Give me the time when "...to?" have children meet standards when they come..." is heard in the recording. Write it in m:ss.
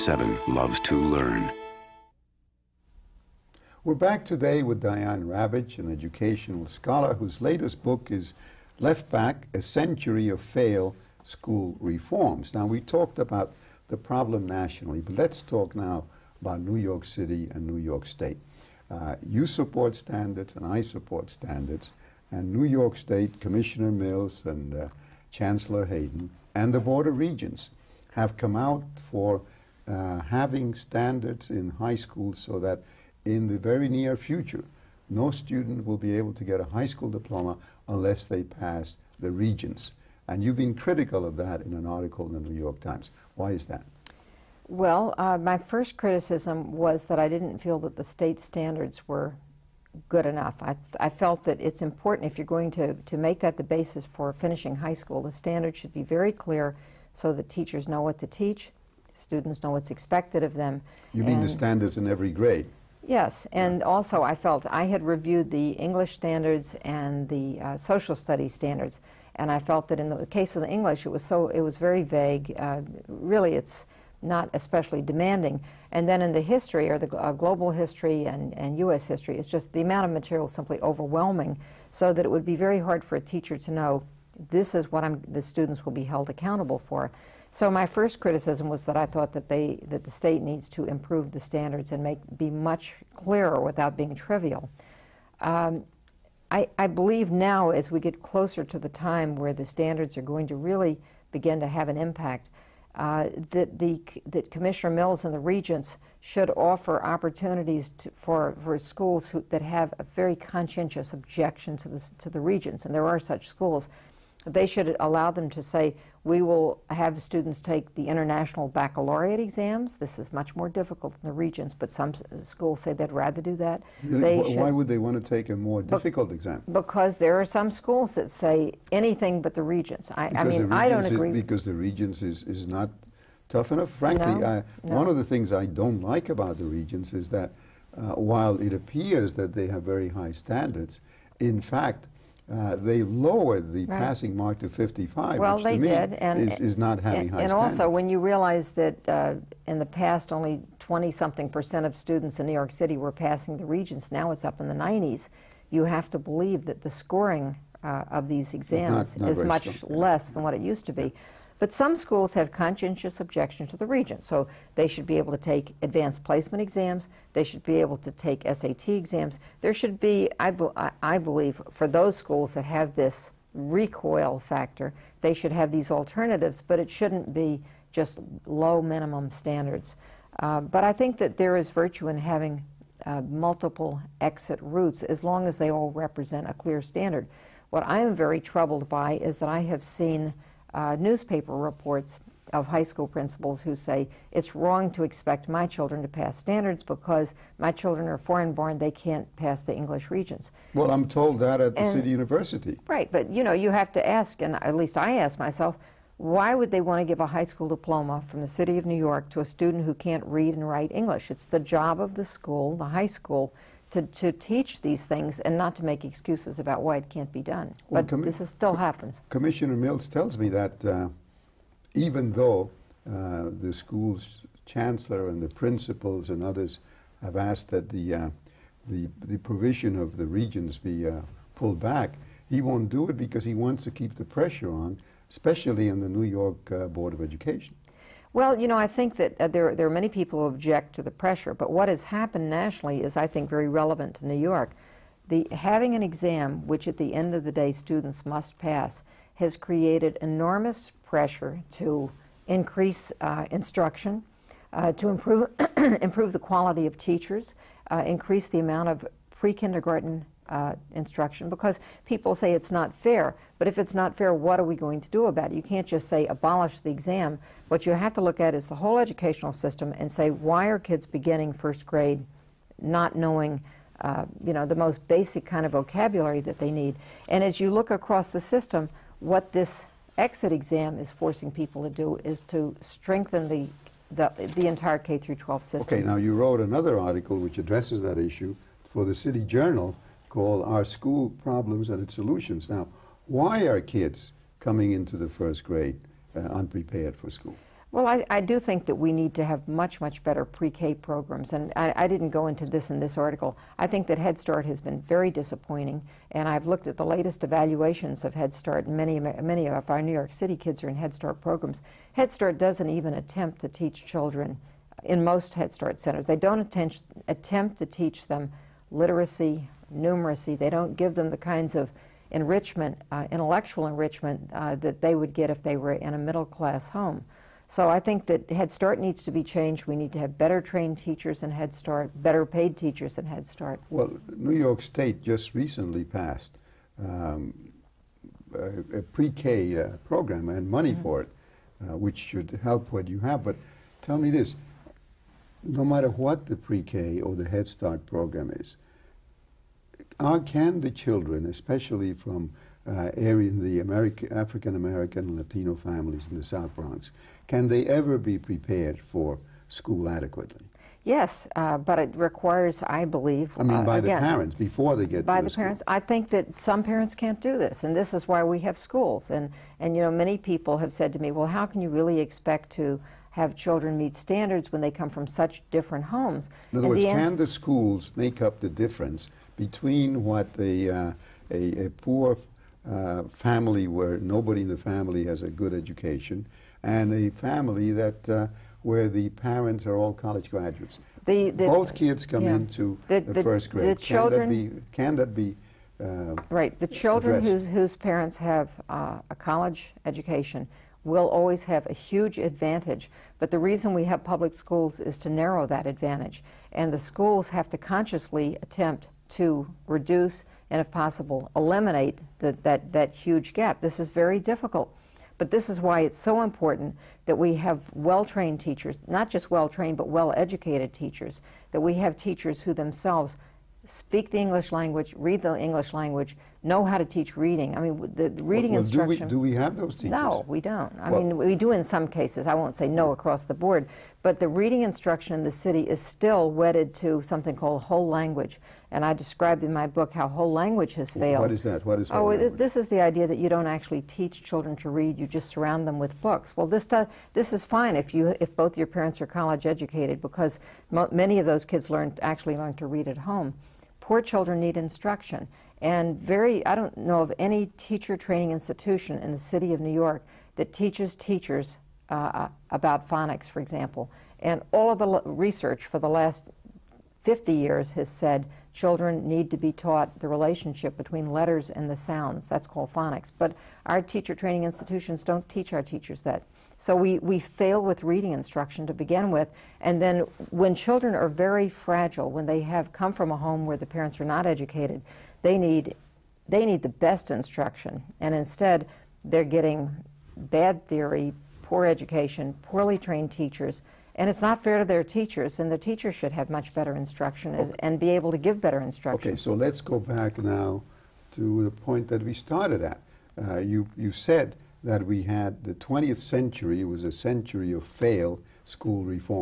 6:12.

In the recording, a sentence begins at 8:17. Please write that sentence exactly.
and be able to give better instruction.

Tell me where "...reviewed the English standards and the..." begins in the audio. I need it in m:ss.
1:05.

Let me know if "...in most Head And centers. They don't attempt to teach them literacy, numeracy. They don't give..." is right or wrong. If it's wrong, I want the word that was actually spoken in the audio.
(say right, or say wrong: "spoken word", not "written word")
wrong: "Start", not "And".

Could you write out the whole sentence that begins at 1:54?
They should allow them to say, we will have students take the international baccalaureate exams.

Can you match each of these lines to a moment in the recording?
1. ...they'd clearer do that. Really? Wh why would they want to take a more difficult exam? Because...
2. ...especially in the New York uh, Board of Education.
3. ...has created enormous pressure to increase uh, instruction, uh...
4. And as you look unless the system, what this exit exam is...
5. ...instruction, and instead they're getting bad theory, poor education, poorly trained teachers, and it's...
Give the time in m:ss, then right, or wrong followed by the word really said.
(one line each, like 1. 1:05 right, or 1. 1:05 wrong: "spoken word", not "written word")
1. 2:02 wrong: "rather", not "clearer"
2. 3:55 right
3. 4:09 right
4. 4:37 wrong: "across", not "unless"
5. 8:07 right.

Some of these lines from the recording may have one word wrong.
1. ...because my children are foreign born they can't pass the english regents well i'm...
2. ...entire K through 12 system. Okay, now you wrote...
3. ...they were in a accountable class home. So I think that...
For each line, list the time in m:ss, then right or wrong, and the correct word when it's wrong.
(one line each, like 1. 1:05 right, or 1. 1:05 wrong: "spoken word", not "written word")
1. 3:16 right
2. 4:44 right
3. 5:25 wrong: "middle", not "accountable".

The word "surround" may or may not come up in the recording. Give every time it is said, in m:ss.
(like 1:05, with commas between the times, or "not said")
7:25.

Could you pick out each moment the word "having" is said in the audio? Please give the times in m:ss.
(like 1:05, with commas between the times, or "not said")
0:30, 2:26, 3:02, 4:05.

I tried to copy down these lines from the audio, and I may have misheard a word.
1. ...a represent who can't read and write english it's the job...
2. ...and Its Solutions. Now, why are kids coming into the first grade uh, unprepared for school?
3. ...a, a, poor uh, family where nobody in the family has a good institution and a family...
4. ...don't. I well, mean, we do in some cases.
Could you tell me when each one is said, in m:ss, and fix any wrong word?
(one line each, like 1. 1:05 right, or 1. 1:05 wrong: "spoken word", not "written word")
1. 3:29 wrong: "student", not "represent"
2. 4:51 right
3. 6:21 wrong: "education", not "institution"
4. 7:10 right.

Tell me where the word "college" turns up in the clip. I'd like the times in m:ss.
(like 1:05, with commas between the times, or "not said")
6:30, 6:39, 7:29.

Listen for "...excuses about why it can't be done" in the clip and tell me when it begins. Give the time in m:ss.
3:36.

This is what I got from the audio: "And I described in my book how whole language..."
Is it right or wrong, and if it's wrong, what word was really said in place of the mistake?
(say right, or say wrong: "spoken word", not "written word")
right.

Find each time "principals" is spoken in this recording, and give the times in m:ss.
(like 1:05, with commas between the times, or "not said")
3:13, 3:45.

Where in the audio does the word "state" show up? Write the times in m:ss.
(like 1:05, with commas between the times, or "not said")
0:18, 0:22, 0:48, 1:30, 5:34.